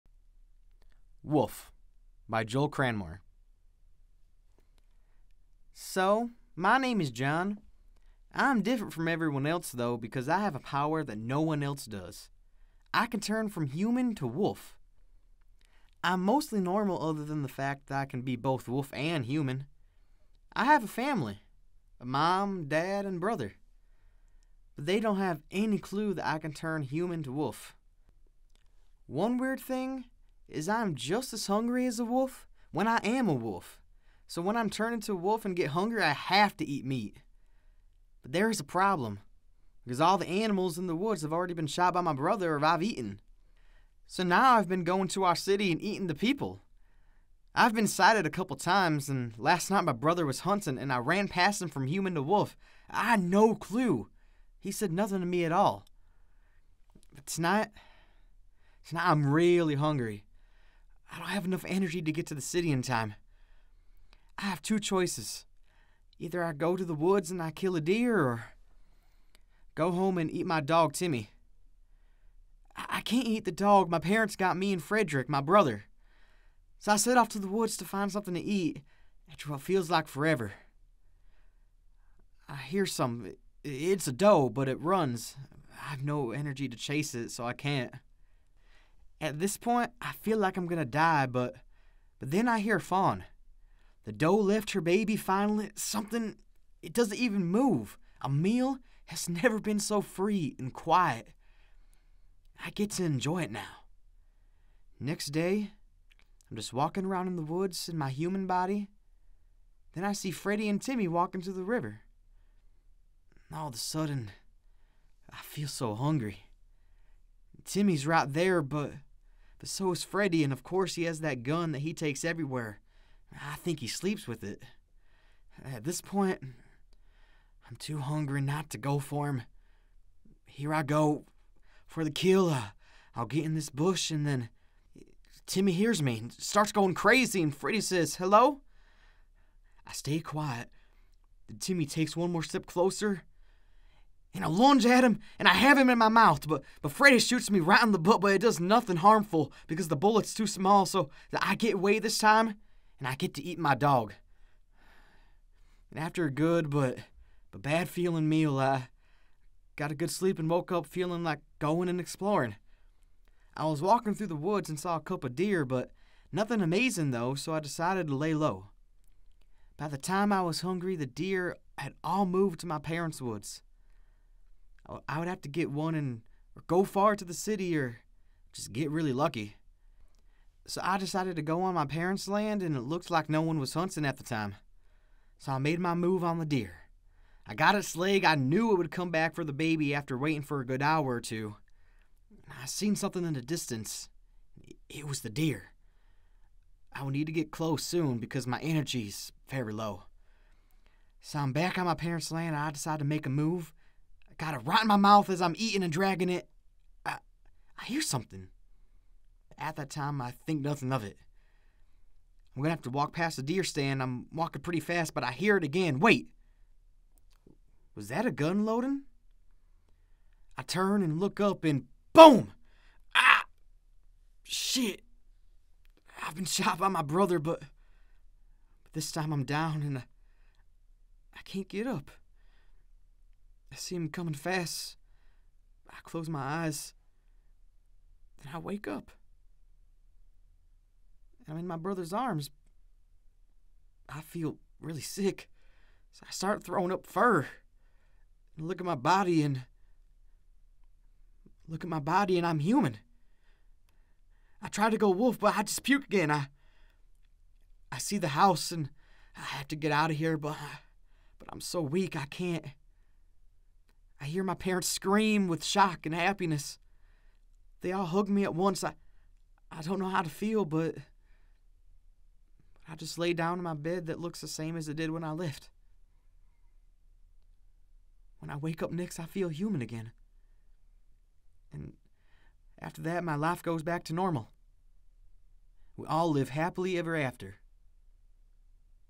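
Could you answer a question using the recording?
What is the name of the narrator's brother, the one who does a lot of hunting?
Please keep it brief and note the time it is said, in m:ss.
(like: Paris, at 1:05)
Frederick, at 1:14.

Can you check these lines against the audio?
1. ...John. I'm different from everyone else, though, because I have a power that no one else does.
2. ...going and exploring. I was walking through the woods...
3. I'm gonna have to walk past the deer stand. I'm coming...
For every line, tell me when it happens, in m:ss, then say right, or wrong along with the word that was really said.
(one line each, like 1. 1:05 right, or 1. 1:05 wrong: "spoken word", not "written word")
1. 0:07 right
2. 2:41 right
3. 3:32 wrong: "walking", not "coming".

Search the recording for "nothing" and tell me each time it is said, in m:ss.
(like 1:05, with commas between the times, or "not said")
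0:54, 2:28, 2:46, 3:30.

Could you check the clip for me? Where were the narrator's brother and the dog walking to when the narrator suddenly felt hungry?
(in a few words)
The river.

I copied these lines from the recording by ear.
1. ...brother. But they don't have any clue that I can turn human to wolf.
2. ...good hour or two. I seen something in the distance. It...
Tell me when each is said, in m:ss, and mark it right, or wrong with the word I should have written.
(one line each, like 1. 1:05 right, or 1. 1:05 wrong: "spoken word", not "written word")
1. 0:23 right
2. 3:10 right.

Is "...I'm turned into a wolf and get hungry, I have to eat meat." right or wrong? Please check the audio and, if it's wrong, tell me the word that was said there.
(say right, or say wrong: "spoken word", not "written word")
right.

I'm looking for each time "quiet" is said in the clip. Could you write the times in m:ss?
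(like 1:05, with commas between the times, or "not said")
1:40, 2:20.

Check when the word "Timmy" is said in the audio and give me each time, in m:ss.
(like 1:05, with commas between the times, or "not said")
1:10, 1:50, 1:57, 2:15, 2:21.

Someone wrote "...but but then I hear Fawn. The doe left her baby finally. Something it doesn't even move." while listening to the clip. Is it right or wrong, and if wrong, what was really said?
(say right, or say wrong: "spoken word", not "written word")
right.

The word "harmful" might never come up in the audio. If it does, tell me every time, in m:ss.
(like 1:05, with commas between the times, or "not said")
2:28.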